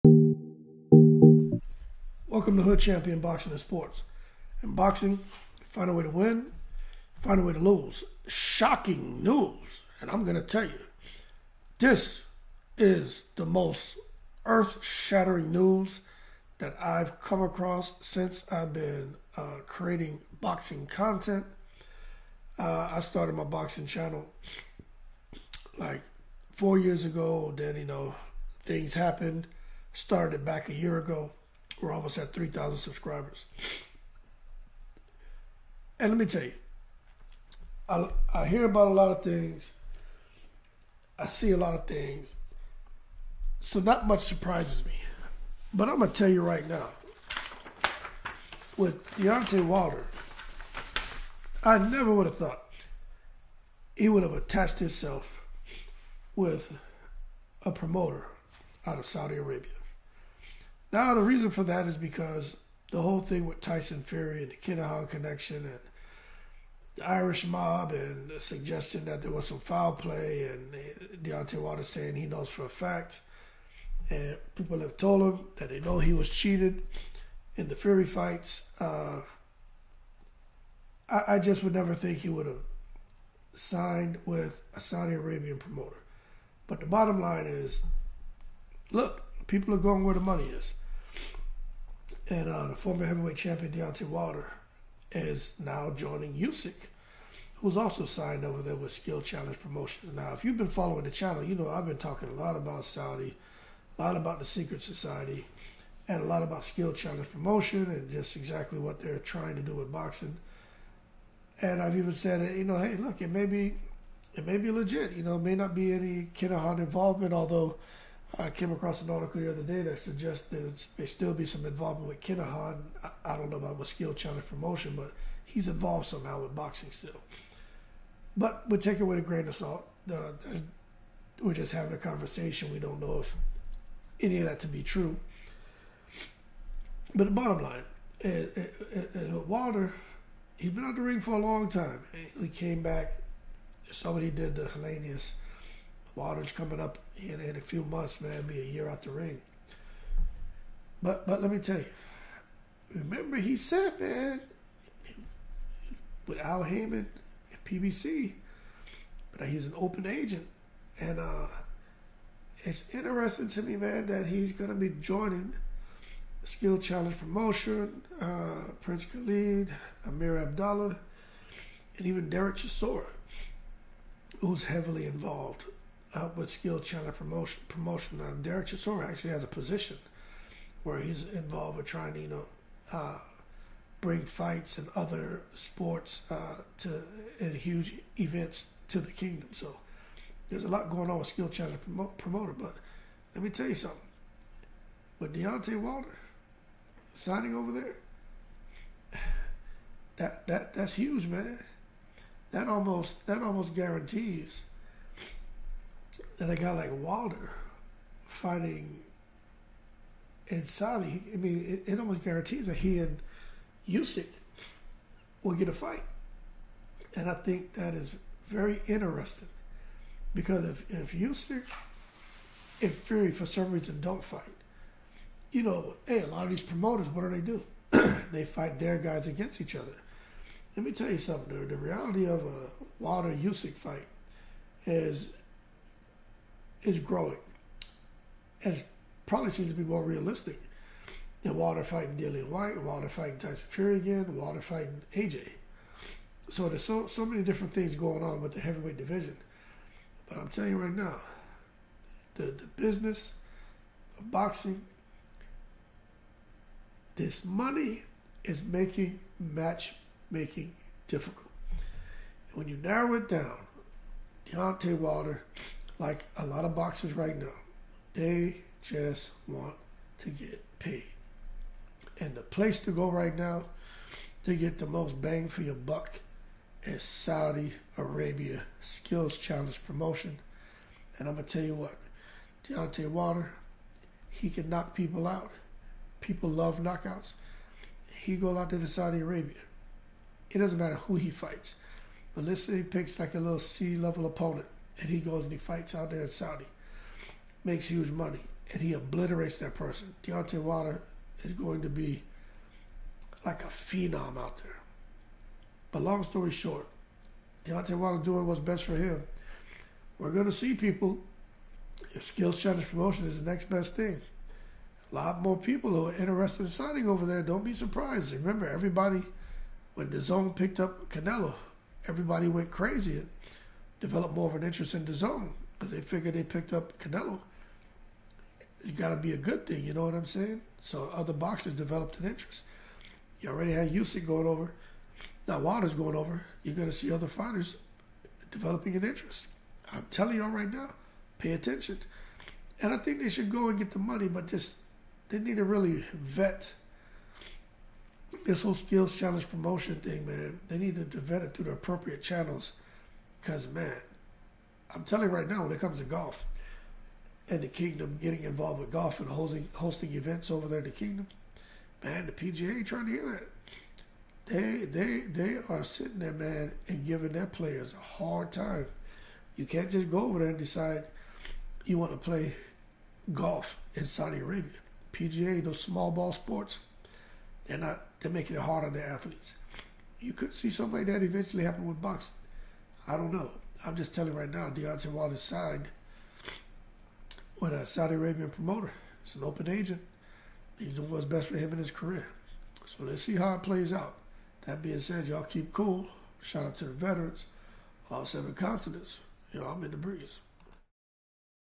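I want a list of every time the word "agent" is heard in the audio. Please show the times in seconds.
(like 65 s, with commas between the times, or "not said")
160 s, 389 s.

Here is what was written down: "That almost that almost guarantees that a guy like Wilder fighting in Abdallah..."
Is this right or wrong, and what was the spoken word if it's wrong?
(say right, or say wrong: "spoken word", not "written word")
wrong: "Saudi", not "Abdallah".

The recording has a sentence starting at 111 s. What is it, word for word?
And I've even said, you know, hey, look, it may be, it may be legit.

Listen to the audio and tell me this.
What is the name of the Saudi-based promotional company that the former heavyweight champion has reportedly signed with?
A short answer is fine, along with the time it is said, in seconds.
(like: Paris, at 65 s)
Skill Challenge Promotions, at 98 s.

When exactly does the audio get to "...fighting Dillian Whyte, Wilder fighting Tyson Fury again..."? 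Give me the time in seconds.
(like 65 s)
241 s.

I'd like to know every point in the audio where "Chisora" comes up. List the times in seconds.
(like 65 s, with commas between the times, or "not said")
172 s, 178 s.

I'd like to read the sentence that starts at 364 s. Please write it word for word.
They, they, they are sitting there, man, and giving their players a hard time.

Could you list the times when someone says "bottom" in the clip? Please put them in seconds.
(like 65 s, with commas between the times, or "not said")
86 s, 137 s.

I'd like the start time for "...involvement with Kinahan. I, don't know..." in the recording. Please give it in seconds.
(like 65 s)
121 s.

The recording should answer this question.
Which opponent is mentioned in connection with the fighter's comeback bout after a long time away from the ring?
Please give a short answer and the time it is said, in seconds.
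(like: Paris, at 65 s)
Helenius, at 144 s.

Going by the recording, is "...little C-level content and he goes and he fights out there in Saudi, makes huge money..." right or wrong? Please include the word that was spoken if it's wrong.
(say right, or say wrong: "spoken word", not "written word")
wrong: "opponent", not "content".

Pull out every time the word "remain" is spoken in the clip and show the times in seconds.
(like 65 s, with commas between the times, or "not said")
not said.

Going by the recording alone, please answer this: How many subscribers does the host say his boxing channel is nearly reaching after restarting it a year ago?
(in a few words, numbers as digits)
3,000.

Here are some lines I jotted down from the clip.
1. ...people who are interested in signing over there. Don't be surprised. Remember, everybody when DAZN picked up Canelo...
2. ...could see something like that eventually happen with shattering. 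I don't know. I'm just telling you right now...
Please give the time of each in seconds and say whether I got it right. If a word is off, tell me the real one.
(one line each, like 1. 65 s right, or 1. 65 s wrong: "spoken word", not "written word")
1. 315 s right
2. 380 s wrong: "boxing", not "shattering".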